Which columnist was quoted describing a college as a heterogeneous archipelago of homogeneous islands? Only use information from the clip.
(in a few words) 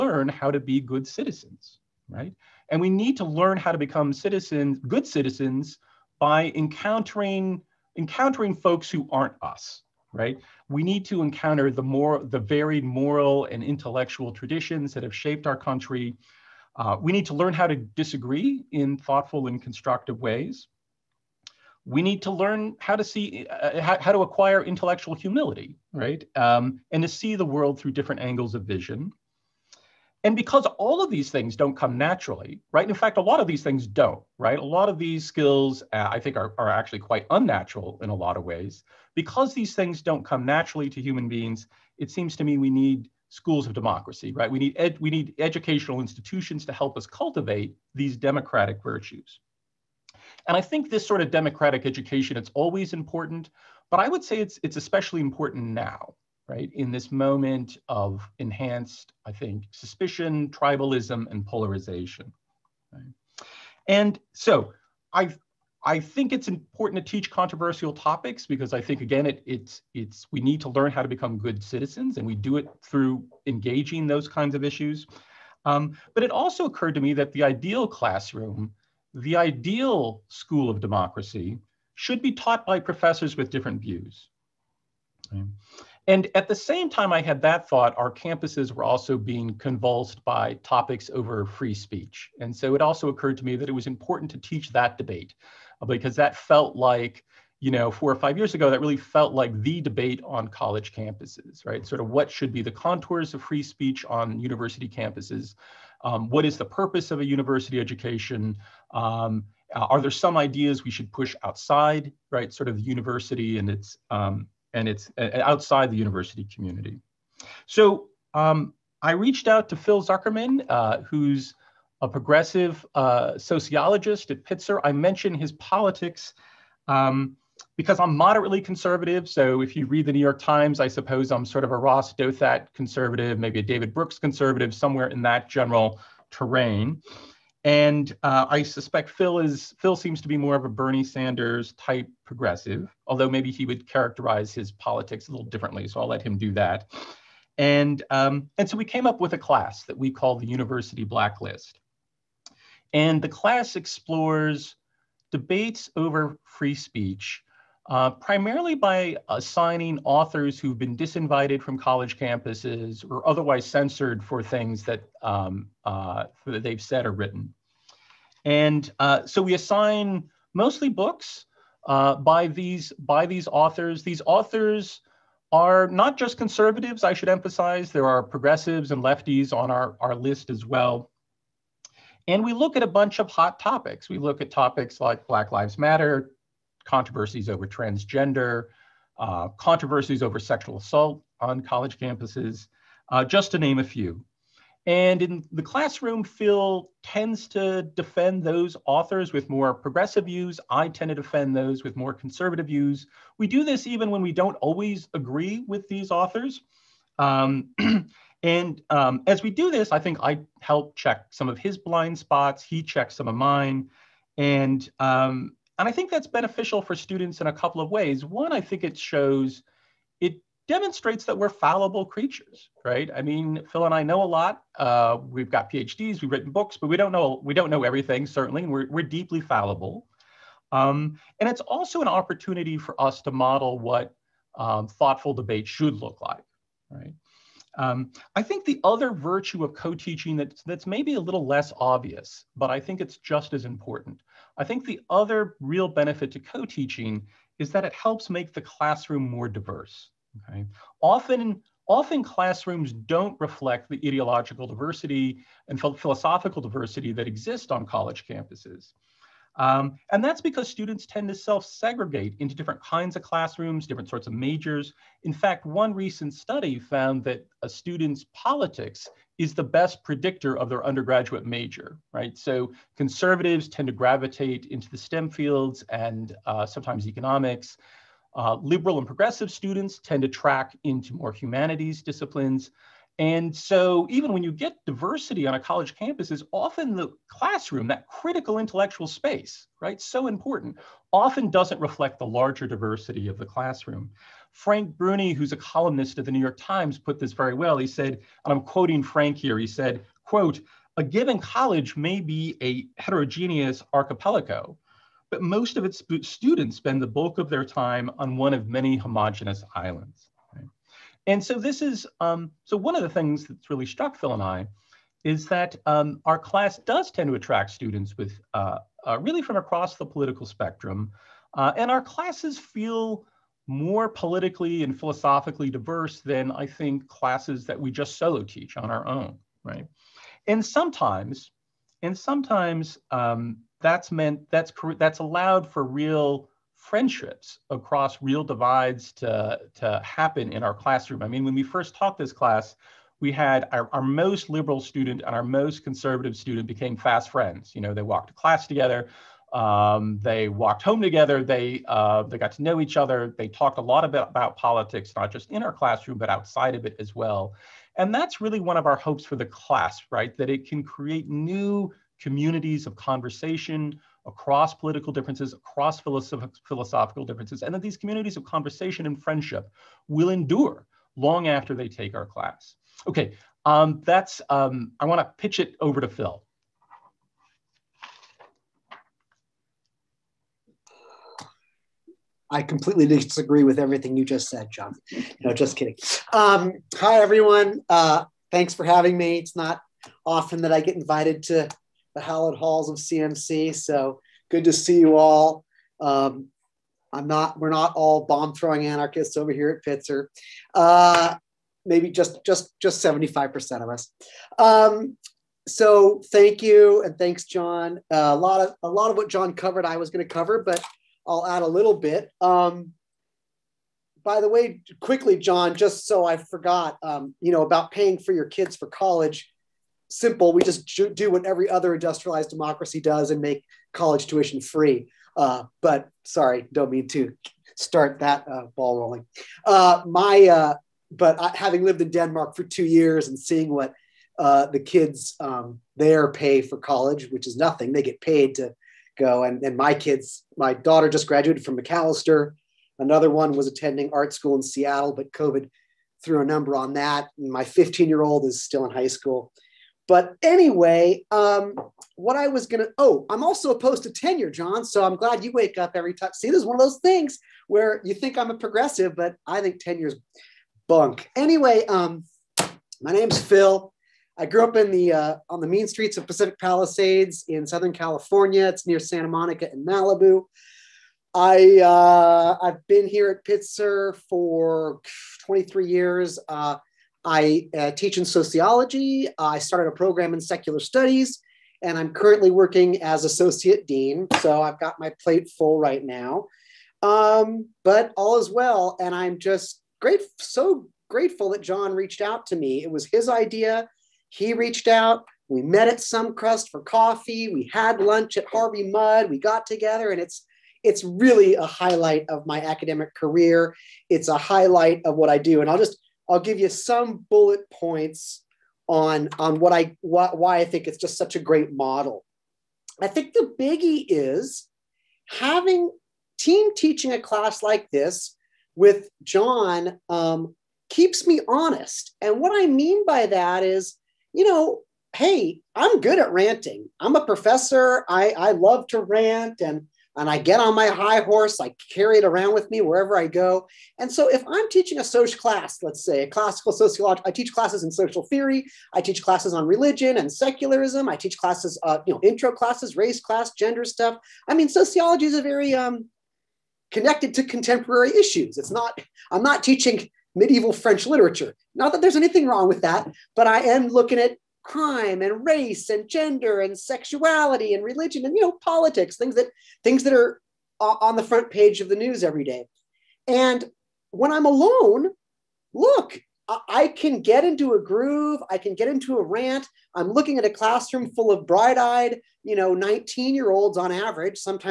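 Frank Bruni.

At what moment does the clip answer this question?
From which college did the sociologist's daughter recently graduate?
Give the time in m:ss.
7:21.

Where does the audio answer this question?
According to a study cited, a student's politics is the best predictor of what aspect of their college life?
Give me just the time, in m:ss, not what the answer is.
4:30.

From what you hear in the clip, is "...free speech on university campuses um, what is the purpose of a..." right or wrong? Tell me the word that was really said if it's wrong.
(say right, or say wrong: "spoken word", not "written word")
right.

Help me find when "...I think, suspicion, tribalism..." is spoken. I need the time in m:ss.
0:59.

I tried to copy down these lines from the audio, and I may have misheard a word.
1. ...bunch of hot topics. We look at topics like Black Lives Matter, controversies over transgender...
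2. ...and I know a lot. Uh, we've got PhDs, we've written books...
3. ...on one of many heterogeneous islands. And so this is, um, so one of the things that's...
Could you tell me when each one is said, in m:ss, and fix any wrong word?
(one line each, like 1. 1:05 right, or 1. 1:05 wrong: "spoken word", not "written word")
1. 3:02 right
2. 3:43 right
3. 5:08 wrong: "homogenous", not "heterogeneous".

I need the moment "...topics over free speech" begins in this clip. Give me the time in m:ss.
1:30.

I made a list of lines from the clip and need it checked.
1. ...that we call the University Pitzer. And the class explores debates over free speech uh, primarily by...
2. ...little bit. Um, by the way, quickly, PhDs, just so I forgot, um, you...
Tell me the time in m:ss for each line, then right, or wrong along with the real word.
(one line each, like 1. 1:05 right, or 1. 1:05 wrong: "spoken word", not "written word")
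1. 2:29 wrong: "Blacklist", not "Pitzer"
2. 6:51 wrong: "Jon", not "PhDs".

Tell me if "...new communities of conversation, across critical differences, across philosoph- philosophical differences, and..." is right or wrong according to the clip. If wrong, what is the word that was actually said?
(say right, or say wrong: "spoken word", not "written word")
wrong: "political", not "critical".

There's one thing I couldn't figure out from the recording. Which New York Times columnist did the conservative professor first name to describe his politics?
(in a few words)
Ross Douthat.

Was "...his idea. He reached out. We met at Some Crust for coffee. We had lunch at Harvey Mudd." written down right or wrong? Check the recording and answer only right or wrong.
right.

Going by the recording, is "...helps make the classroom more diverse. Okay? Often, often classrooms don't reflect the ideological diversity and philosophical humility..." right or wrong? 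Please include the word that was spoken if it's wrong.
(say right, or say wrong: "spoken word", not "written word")
wrong: "diversity", not "humility".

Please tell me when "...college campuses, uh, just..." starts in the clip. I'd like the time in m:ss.
3:11.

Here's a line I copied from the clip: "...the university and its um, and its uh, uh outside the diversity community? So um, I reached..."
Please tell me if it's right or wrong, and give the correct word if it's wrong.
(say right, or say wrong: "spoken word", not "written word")
wrong: "university", not "diversity".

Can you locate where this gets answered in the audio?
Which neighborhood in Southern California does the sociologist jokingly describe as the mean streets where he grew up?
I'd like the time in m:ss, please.
7:46.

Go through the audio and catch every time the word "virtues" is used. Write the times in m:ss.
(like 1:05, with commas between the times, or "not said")
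0:48, 3:59.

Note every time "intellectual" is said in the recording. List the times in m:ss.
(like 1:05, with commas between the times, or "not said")
0:13, 0:24, 4:48.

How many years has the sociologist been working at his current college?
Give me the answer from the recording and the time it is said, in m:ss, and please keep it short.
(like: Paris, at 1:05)
23, at 7:55.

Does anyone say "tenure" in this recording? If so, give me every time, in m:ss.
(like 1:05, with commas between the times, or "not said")
7:34, 7:39.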